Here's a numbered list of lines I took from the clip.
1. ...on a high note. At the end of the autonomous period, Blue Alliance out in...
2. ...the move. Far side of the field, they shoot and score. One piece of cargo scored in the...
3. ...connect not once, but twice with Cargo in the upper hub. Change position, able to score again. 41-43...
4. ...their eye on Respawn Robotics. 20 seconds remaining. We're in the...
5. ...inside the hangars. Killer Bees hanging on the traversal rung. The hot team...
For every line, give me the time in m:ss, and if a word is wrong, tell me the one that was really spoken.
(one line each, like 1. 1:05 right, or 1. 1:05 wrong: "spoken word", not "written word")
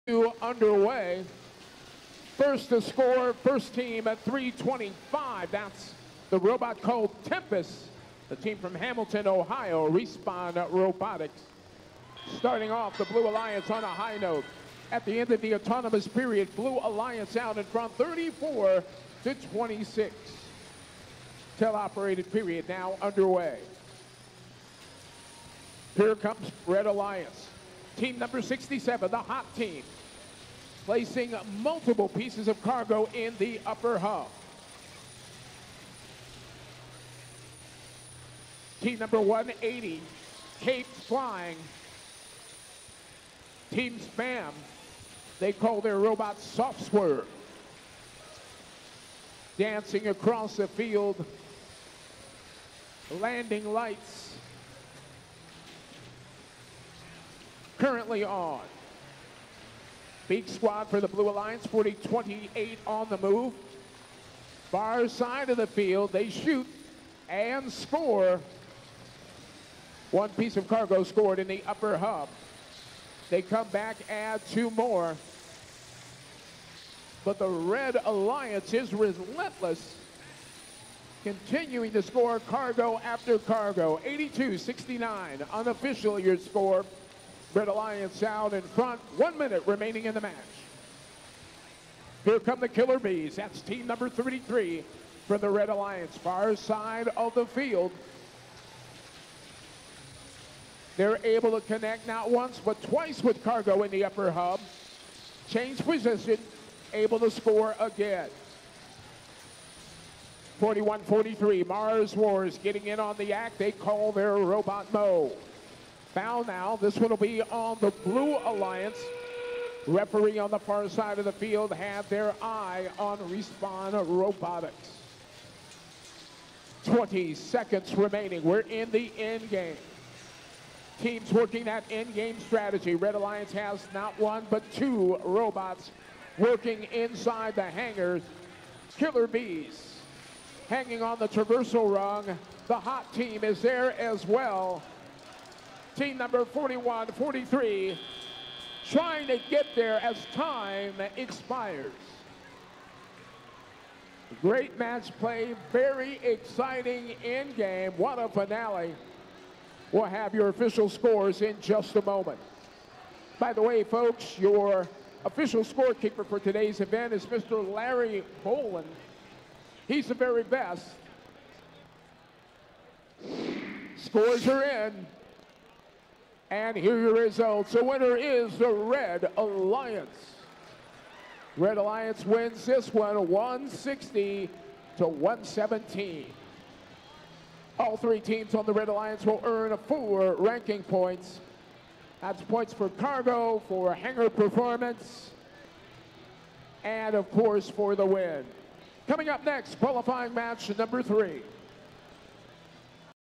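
1. 0:13 right
2. 1:03 right
3. 1:41 right
4. 2:02 right
5. 2:16 right.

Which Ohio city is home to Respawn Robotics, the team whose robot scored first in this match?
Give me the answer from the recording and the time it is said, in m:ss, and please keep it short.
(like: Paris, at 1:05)
Hamilton, at 0:08.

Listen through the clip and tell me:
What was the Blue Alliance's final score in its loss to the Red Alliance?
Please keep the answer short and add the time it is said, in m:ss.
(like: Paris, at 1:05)
117, at 3:05.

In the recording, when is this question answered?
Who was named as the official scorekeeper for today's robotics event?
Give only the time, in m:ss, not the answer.
2:47.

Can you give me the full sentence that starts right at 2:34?
Great match play, very exciting end game.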